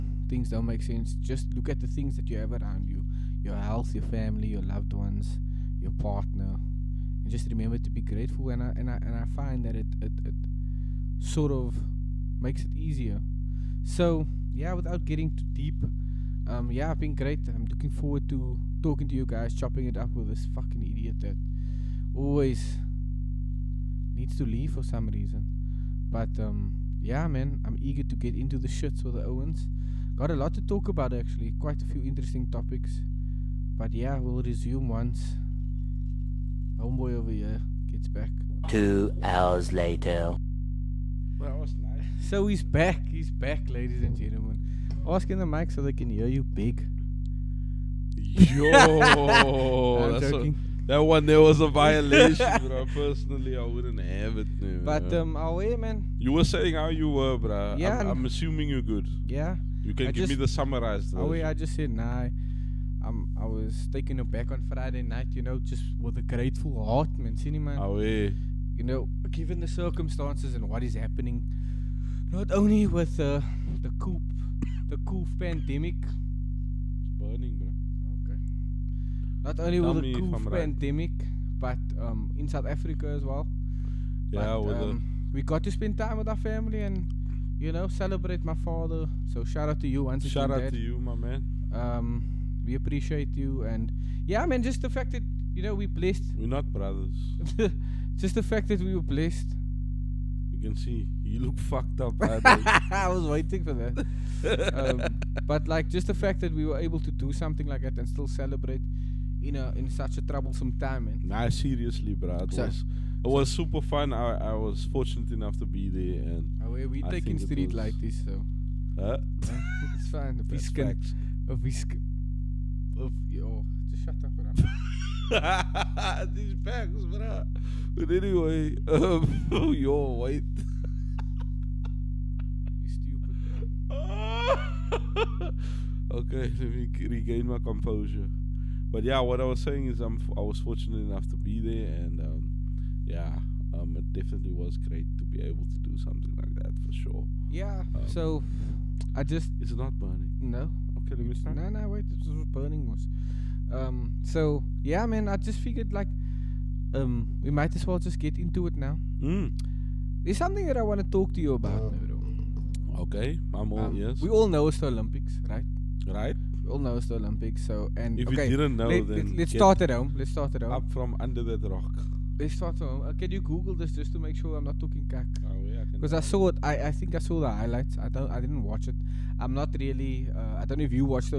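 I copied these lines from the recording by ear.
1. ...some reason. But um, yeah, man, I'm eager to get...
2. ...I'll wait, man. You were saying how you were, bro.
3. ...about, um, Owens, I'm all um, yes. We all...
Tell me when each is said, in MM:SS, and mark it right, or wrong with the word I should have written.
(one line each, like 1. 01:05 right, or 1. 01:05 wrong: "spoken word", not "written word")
1. 00:24 right
2. 00:55 right
3. 02:41 wrong: "Okay", not "Owens".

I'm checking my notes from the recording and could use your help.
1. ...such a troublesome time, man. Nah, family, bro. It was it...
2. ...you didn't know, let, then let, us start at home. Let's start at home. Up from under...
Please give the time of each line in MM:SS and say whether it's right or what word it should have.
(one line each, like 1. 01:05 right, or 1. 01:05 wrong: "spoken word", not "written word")
1. 01:49 wrong: "seriously", not "family"
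2. 02:48 right.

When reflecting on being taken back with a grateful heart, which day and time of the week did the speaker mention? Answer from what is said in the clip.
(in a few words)
Friday night.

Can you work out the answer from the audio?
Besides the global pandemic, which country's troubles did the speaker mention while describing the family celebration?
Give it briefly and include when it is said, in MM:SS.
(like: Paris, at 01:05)
South Africa, at 01:22.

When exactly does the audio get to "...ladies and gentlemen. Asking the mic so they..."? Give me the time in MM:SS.
00:43.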